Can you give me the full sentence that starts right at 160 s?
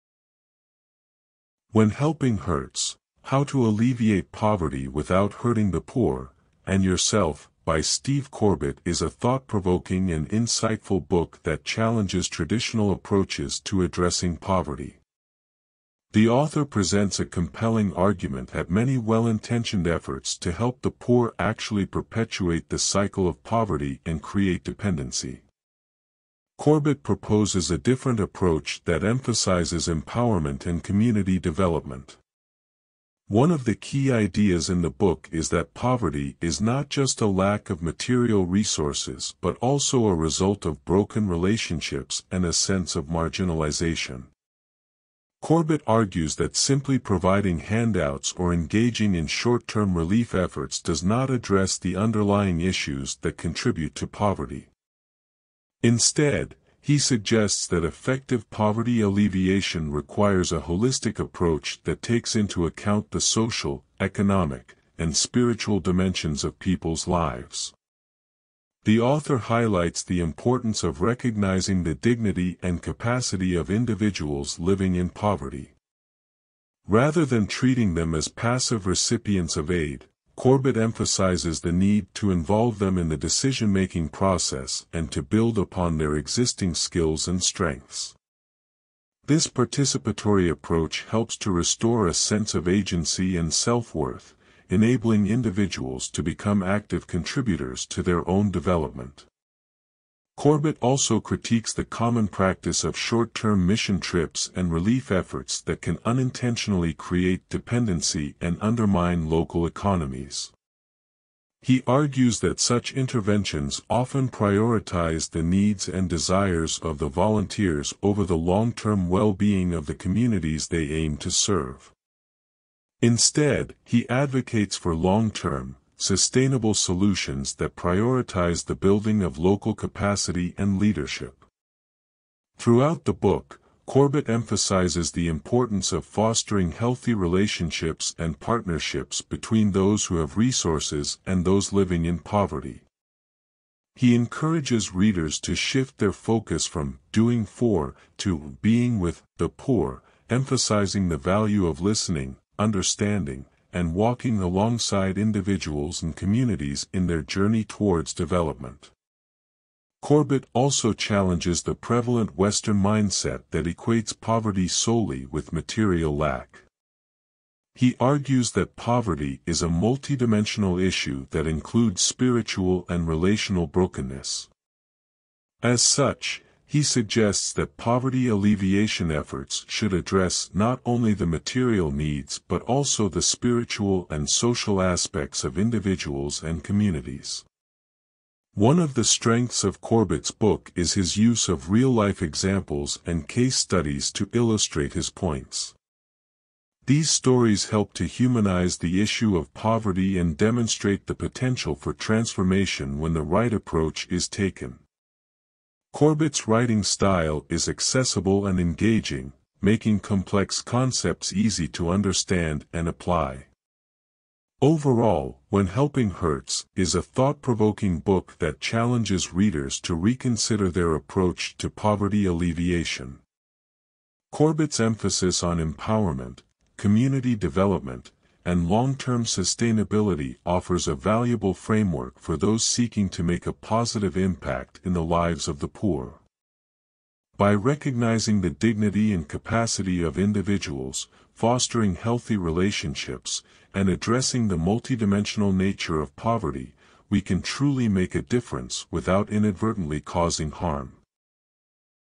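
Corbett also challenges the prevalent Western mindset that equates poverty solely with material lack.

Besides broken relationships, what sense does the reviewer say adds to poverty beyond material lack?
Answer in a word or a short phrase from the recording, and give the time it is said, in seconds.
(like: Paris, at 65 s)
marginalization, at 43 s.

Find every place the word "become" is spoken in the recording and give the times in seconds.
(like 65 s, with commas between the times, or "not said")
96 s.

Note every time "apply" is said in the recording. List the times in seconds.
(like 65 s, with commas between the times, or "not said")
212 s.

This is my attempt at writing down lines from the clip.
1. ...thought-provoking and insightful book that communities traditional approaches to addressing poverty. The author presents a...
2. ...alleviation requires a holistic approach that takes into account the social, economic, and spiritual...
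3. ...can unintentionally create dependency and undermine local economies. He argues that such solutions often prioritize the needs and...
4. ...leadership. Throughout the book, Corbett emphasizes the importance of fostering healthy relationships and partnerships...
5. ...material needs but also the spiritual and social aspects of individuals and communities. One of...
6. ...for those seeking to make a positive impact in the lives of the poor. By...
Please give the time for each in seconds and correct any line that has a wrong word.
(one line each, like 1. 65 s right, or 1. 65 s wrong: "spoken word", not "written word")
1. 9 s wrong: "challenges", not "communities"
2. 59 s right
3. 105 s wrong: "interventions", not "solutions"
4. 130 s right
5. 181 s right
6. 232 s right.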